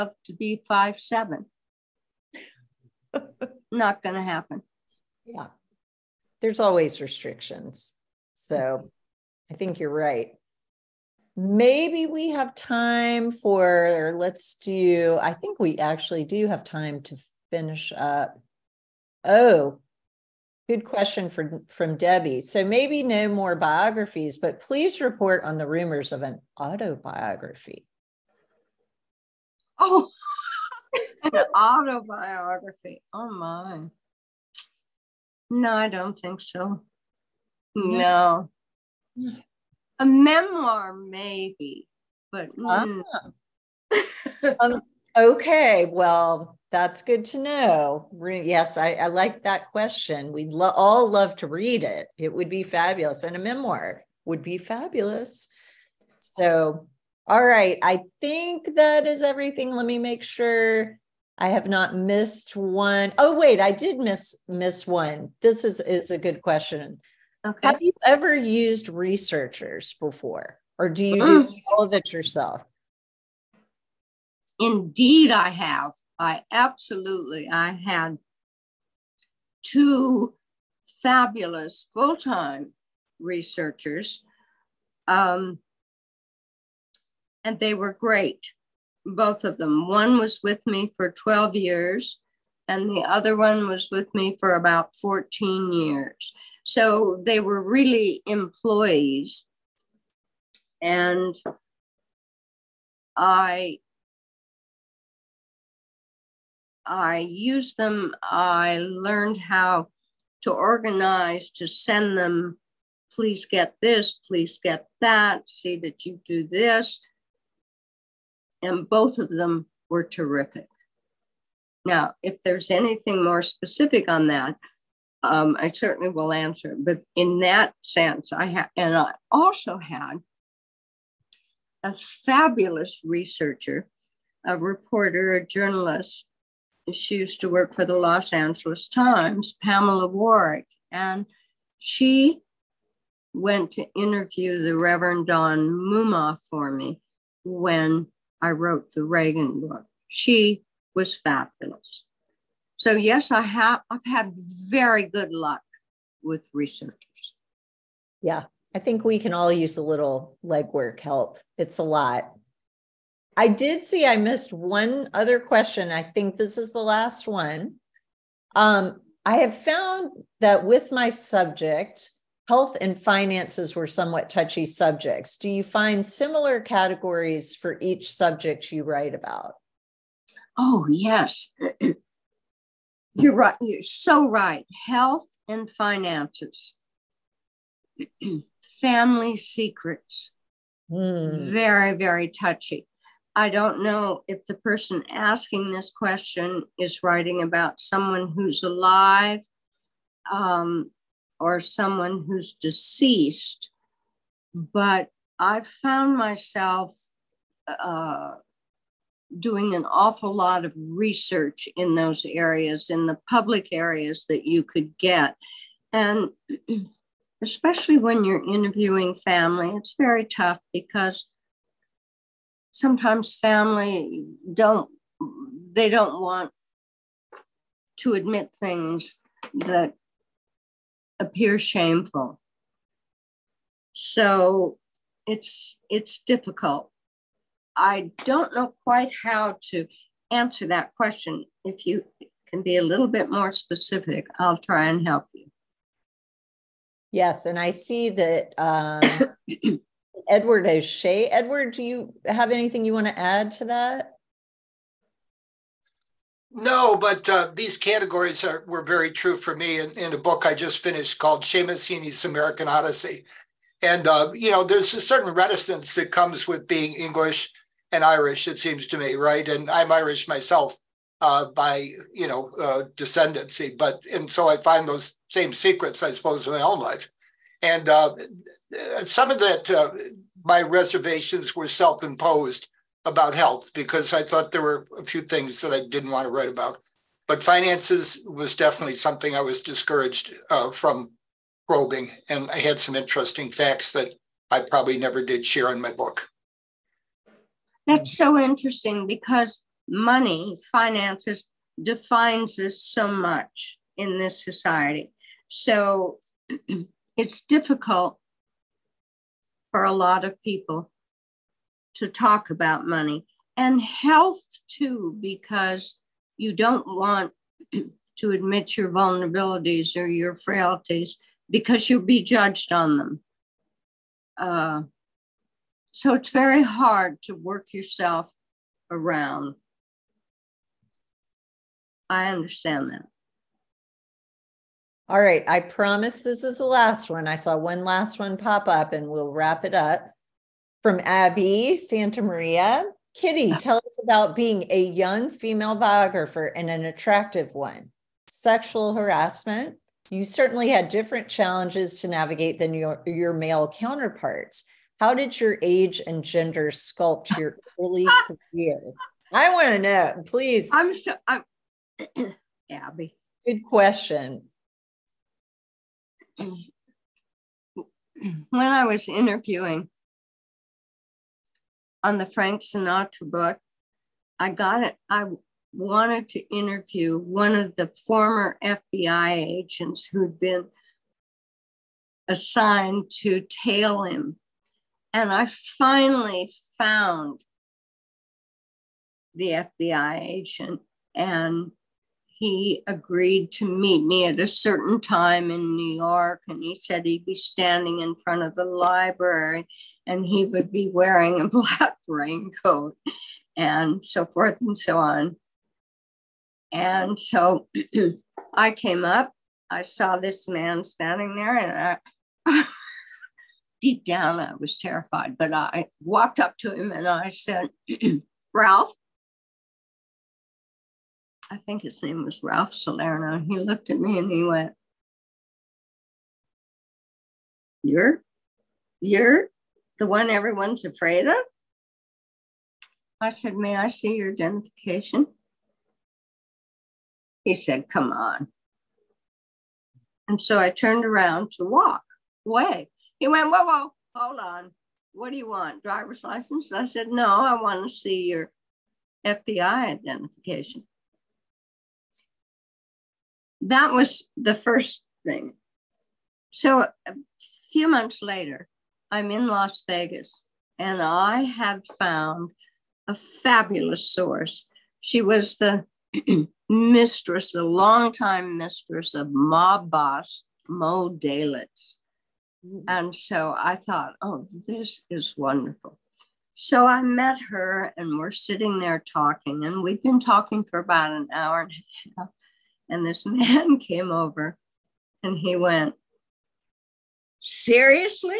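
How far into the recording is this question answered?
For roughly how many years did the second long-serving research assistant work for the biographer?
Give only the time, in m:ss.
1:34.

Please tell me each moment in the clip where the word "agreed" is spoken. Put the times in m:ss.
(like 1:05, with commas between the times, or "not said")
6:32.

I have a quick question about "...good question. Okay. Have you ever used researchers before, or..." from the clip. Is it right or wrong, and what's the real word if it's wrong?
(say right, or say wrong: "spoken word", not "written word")
right.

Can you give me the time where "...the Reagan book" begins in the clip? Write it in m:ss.
2:28.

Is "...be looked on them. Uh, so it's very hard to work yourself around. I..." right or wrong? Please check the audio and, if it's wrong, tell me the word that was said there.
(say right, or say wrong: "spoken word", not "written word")
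wrong: "judged", not "looked".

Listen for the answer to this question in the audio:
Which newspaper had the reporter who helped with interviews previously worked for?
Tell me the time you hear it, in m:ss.
2:17.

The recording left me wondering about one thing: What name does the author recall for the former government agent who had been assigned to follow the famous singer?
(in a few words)
Ralph Salerno.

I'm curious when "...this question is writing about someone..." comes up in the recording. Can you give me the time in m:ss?
3:15.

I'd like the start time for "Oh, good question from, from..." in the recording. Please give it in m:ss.
0:19.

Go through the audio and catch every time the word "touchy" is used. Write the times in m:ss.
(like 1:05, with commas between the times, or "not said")
2:54, 3:12.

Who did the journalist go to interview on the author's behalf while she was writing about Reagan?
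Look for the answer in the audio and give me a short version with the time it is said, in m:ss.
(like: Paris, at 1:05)
Reverend Don Mumma, at 2:24.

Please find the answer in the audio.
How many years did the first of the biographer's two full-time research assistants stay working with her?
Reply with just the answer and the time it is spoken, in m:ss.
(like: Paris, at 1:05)
12, at 1:31.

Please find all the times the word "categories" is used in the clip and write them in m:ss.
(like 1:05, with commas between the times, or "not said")
2:56, 4:17.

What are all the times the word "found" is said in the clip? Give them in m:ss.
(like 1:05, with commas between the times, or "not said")
2:49, 3:25, 6:26, 7:41.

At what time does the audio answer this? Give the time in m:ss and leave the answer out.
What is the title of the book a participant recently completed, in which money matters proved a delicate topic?
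4:21.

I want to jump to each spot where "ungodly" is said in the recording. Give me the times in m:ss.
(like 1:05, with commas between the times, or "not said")
not said.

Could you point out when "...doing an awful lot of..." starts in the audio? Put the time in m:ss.
3:29.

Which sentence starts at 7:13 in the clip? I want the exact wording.
I said, May I see your identification?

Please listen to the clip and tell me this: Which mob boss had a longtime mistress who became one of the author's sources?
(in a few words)
Mo Dalitz.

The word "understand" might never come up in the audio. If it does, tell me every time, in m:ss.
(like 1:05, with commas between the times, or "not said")
5:32.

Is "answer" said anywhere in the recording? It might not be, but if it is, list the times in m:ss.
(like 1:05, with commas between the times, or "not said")
2:06, 4:00.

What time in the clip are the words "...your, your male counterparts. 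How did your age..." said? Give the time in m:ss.
5:52.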